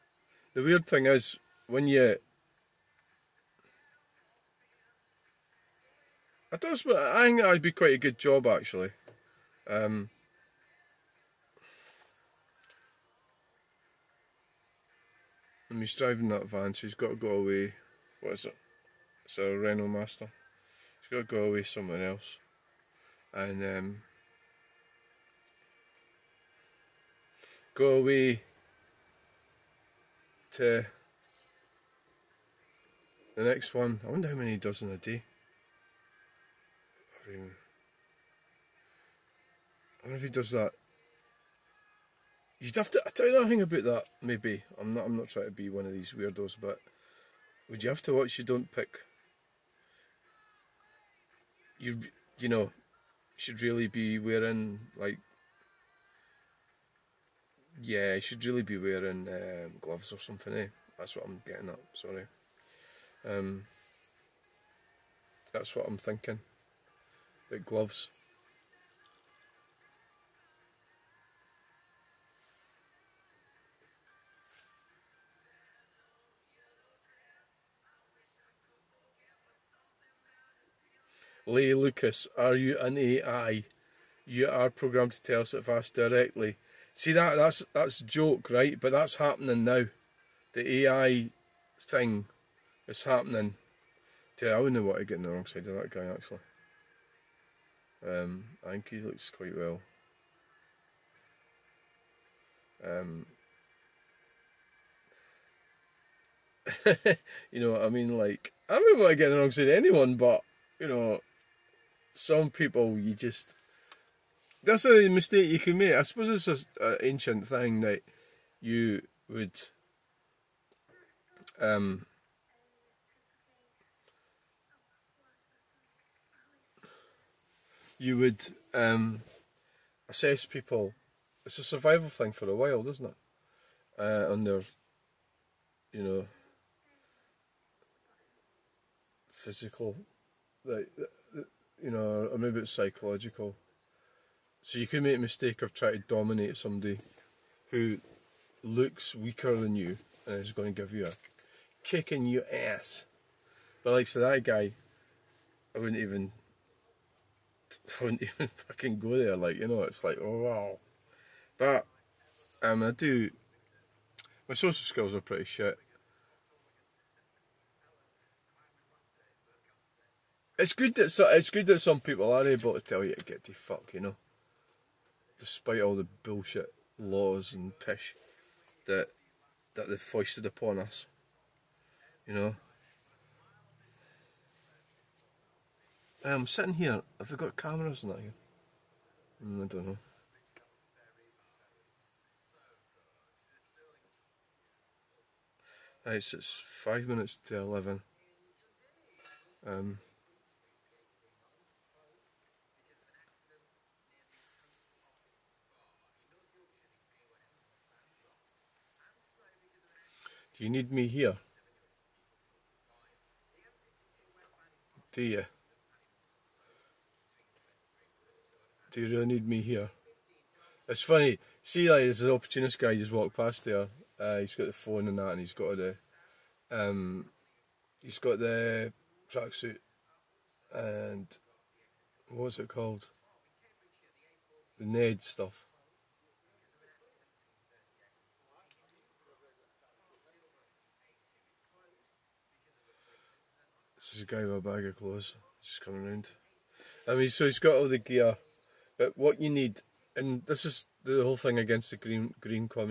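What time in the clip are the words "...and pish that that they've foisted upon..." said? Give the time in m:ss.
2:57.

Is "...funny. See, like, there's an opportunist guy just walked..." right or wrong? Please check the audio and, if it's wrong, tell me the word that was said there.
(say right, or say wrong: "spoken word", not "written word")
right.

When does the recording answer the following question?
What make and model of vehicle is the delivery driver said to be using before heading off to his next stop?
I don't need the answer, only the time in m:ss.
0:19.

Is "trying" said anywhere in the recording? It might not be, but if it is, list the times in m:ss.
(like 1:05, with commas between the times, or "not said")
0:45, 2:25.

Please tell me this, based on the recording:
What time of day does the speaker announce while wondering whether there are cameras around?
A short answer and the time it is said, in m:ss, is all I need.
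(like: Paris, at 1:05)
10:55, at 3:16.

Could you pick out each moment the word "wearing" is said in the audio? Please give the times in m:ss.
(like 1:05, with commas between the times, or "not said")
0:54, 0:58.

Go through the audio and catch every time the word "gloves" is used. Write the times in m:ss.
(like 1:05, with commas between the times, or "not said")
0:59, 1:07.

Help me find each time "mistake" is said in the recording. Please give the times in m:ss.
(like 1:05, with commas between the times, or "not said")
1:55, 2:25.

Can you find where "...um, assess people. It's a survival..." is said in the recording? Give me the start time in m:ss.
2:08.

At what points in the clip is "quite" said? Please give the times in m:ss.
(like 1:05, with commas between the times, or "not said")
0:07, 1:39.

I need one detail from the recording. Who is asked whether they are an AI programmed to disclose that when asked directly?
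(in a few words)
Leigh Lucas.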